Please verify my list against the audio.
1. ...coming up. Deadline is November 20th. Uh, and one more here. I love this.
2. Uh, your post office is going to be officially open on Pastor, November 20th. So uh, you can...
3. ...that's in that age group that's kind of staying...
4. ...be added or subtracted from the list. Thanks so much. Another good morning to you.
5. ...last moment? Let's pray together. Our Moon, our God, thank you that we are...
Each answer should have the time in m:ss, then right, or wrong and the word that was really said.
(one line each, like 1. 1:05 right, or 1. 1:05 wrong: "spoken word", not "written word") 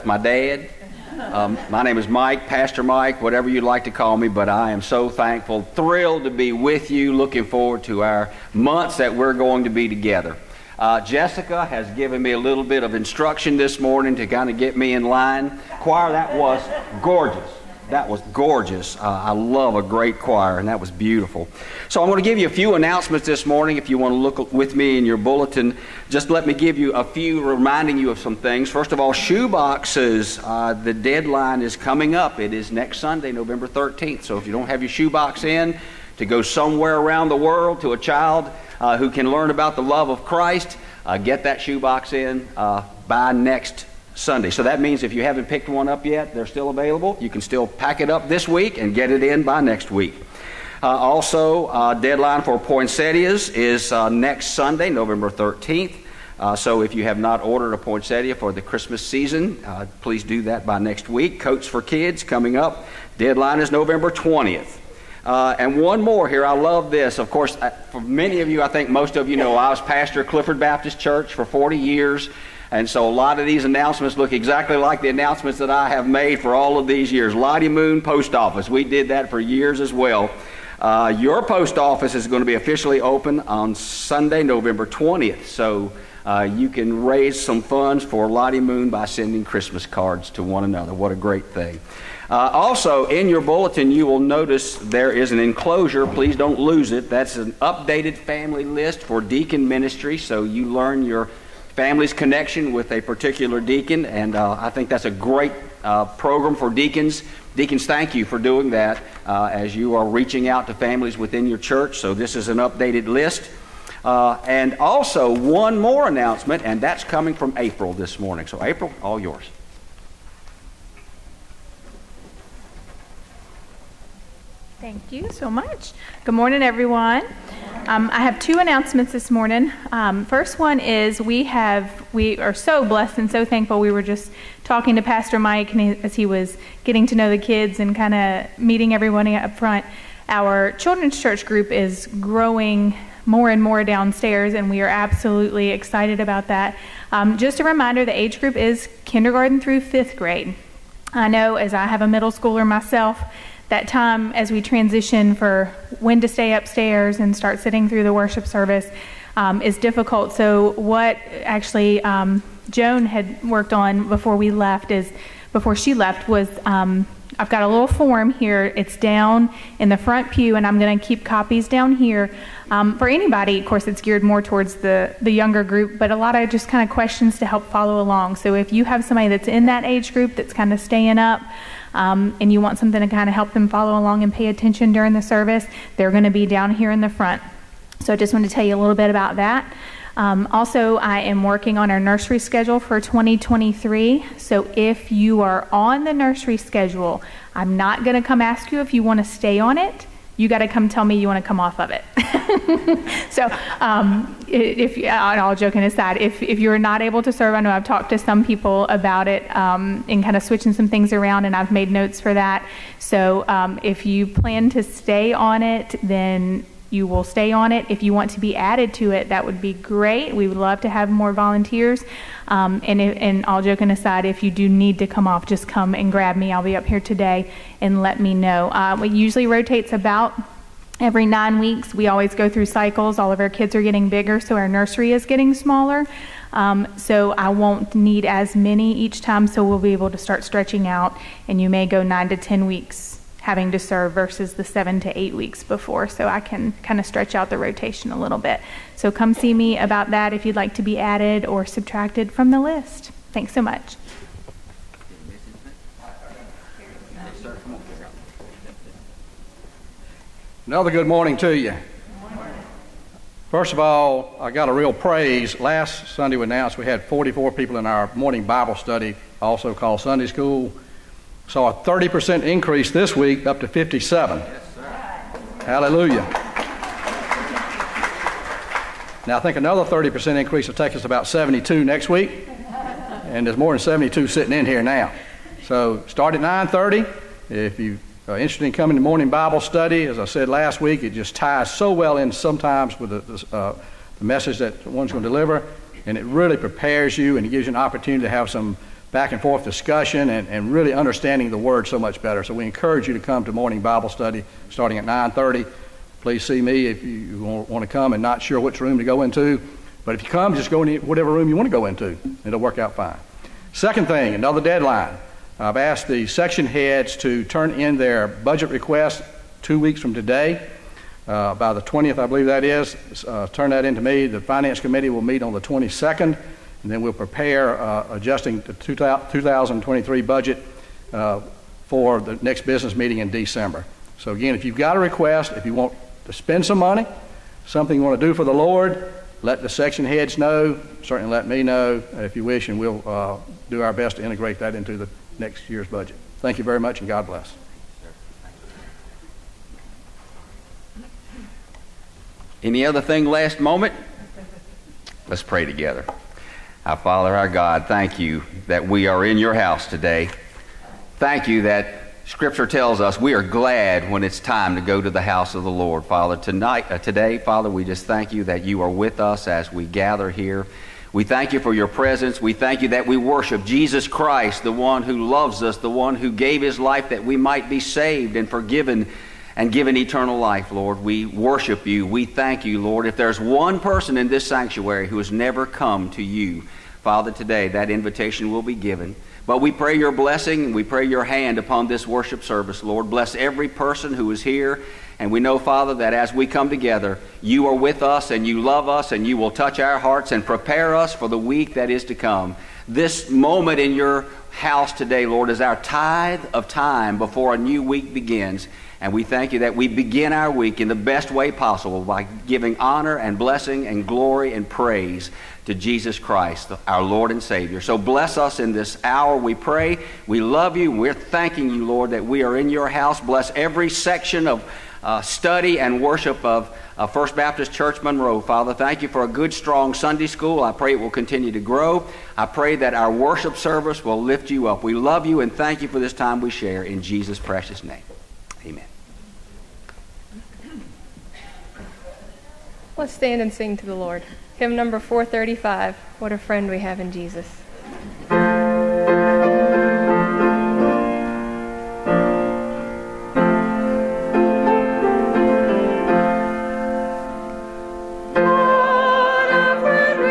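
1. 1:02 right
2. 1:20 wrong: "Sunday", not "Pastor"
3. 2:59 right
4. 4:10 right
5. 5:53 wrong: "Father", not "Moon".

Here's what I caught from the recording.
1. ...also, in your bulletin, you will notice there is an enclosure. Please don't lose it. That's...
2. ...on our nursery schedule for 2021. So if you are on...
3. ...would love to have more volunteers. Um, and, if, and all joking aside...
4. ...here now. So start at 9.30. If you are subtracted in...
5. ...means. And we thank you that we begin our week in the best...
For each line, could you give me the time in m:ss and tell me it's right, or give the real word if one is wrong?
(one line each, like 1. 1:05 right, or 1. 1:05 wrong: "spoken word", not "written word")
1. 1:32 right
2. 3:11 wrong: "2023", not "2021"
3. 3:40 right
4. 4:44 wrong: "interested", not "subtracted"
5. 6:48 wrong: "begins", not "means".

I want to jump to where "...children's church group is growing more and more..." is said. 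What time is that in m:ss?
2:20.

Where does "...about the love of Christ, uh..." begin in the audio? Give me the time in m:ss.
0:39.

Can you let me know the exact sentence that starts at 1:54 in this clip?
Uh, and also, one more announcement, and that's coming from April this morning.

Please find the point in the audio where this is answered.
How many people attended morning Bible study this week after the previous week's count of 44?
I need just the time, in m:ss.
4:33.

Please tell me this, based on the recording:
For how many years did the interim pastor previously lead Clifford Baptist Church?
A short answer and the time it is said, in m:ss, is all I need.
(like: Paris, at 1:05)
40, at 1:11.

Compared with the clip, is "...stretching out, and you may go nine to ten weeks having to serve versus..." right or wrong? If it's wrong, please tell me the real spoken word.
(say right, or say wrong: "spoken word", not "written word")
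right.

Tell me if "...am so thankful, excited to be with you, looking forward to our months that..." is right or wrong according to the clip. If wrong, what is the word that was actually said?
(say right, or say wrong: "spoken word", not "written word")
wrong: "thrilled", not "excited".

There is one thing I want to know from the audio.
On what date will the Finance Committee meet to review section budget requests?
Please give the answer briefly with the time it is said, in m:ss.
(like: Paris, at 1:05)
the 22nd, at 5:25.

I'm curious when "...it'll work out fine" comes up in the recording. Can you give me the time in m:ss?
5:12.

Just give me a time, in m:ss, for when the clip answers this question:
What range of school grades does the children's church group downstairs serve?
2:29.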